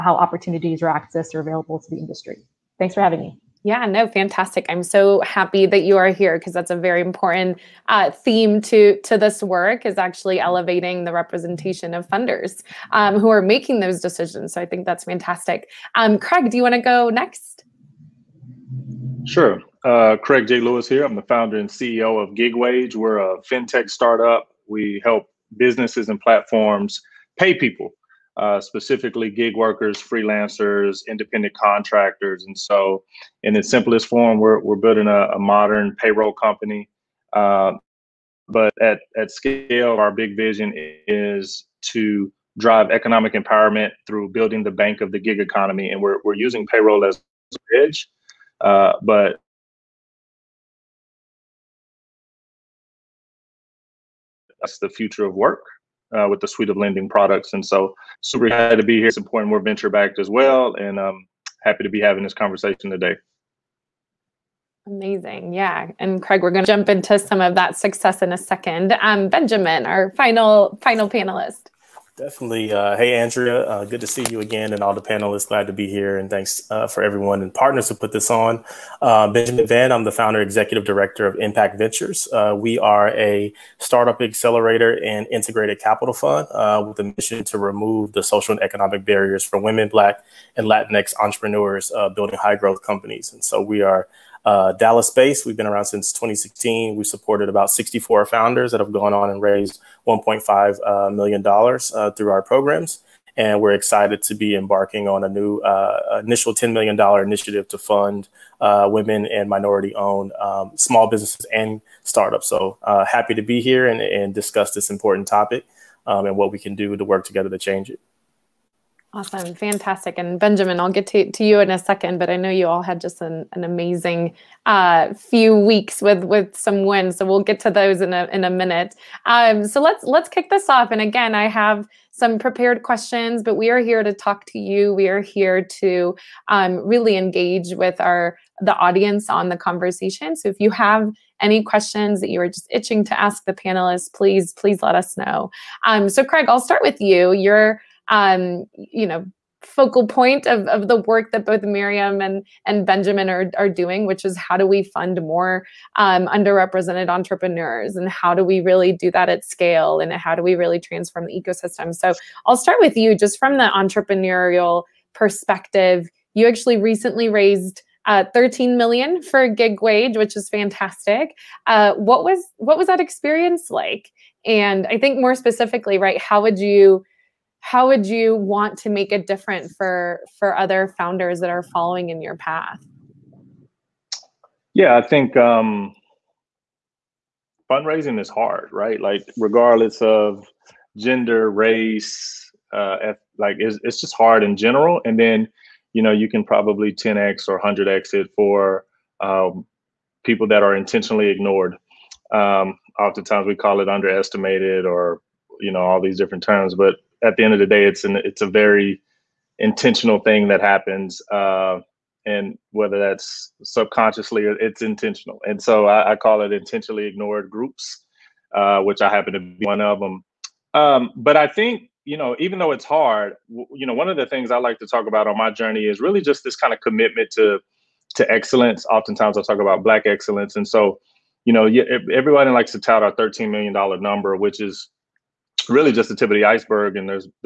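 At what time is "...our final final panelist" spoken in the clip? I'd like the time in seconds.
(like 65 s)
69 s.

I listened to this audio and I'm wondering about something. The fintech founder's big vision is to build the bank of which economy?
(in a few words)
the gig economy.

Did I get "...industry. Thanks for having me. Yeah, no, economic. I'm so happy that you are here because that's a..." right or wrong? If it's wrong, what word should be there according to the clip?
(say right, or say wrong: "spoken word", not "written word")
wrong: "fantastic", not "economic".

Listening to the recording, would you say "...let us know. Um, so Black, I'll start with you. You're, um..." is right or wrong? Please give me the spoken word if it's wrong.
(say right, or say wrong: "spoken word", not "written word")
wrong: "Craig", not "Black".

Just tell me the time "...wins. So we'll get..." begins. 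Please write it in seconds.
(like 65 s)
126 s.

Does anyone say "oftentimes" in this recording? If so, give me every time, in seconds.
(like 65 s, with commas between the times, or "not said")
202 s, 228 s.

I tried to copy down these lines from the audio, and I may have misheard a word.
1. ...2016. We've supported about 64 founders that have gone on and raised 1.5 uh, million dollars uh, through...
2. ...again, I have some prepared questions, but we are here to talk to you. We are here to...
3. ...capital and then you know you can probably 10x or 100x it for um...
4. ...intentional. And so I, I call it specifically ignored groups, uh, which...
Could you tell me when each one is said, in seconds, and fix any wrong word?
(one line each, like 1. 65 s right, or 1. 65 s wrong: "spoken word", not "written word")
1. 96 s right
2. 131 s right
3. 194 s wrong: "general", not "capital"
4. 214 s wrong: "intentionally", not "specifically".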